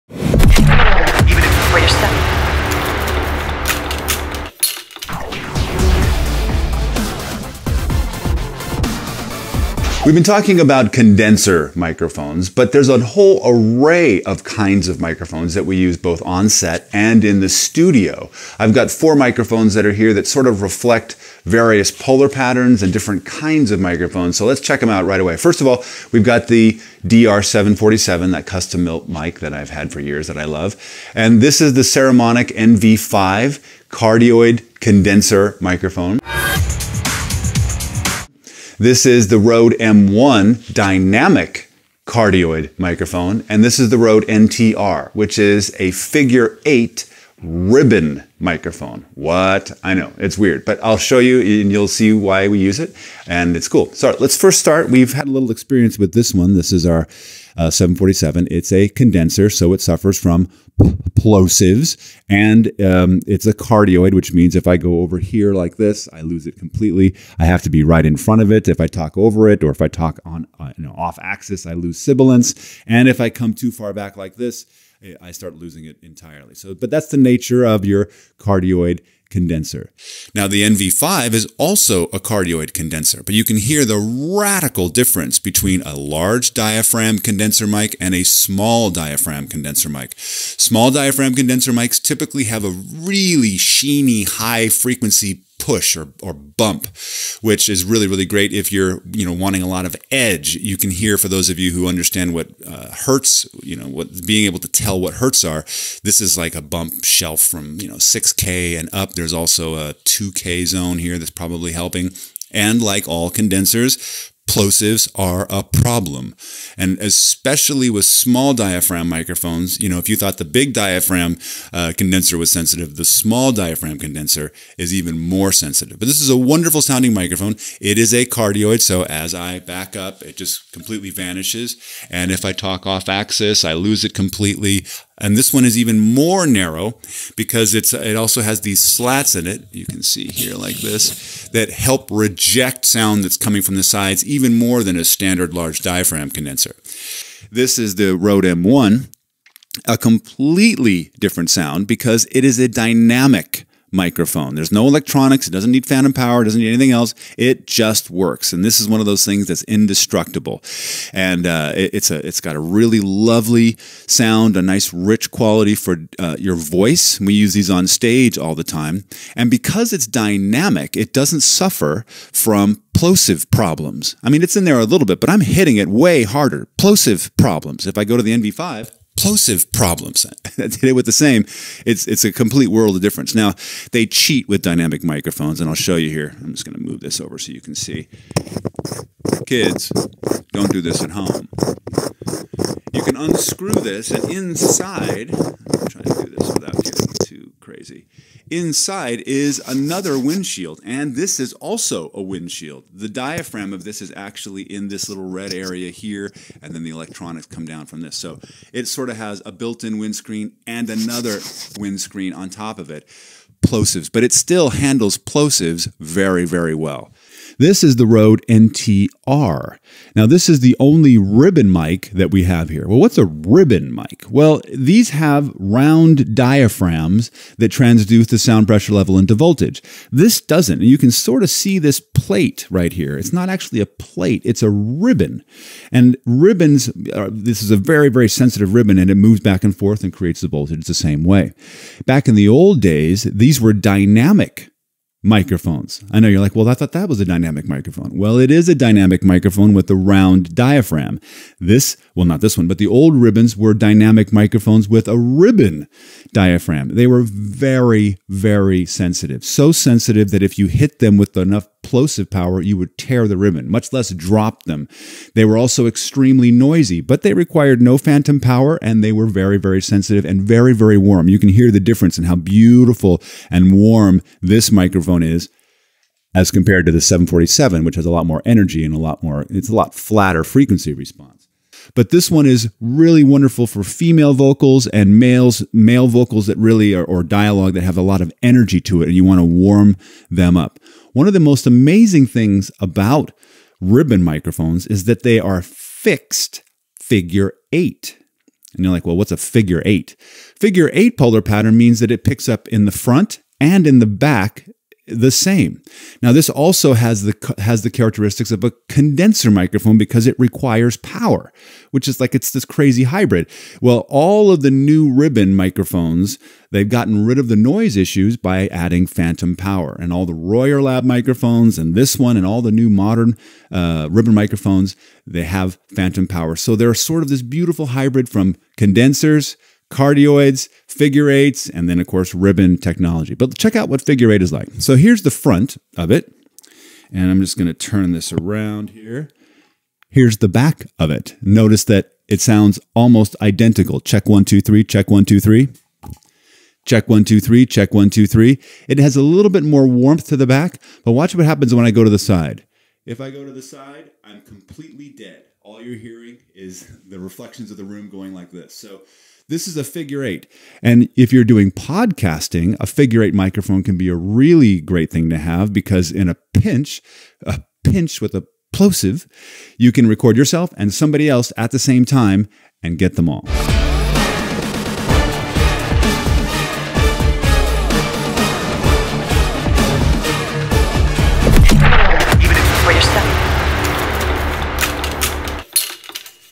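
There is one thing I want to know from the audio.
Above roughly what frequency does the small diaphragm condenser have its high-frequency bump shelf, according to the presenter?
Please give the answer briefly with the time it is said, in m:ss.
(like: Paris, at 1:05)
6K, at 1:47.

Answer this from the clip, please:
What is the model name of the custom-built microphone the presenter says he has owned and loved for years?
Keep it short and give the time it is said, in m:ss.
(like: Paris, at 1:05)
DR747, at 0:27.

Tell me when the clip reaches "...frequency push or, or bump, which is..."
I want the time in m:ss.
1:34.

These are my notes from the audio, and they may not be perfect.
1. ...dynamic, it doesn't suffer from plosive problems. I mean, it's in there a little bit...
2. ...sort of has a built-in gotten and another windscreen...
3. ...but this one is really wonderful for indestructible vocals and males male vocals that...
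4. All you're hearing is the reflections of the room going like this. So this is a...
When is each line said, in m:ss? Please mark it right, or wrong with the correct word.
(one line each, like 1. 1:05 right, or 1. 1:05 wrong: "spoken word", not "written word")
1. 2:50 right
2. 3:28 wrong: "windscreen", not "gotten"
3. 4:41 wrong: "female", not "indestructible"
4. 5:55 right.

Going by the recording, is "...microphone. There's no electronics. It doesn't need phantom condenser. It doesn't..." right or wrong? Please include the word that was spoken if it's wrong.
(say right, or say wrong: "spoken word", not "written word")
wrong: "power", not "condenser".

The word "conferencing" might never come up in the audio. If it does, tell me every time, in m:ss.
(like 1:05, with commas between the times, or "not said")
not said.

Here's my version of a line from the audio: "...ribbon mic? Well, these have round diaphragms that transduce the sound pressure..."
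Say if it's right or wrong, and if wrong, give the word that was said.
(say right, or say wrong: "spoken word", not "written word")
right.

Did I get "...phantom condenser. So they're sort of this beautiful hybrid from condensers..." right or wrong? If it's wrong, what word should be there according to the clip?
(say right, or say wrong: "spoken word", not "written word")
wrong: "power", not "condenser".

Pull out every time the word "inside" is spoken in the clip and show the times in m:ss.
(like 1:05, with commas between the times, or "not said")
3:14, 3:18.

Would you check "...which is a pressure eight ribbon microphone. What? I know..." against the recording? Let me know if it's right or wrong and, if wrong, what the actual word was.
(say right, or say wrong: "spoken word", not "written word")
wrong: "figure", not "pressure".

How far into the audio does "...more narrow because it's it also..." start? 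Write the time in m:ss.
2:15.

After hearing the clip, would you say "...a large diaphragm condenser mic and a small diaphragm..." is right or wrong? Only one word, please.
right.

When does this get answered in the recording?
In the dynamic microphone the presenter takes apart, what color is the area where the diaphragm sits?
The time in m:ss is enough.
3:25.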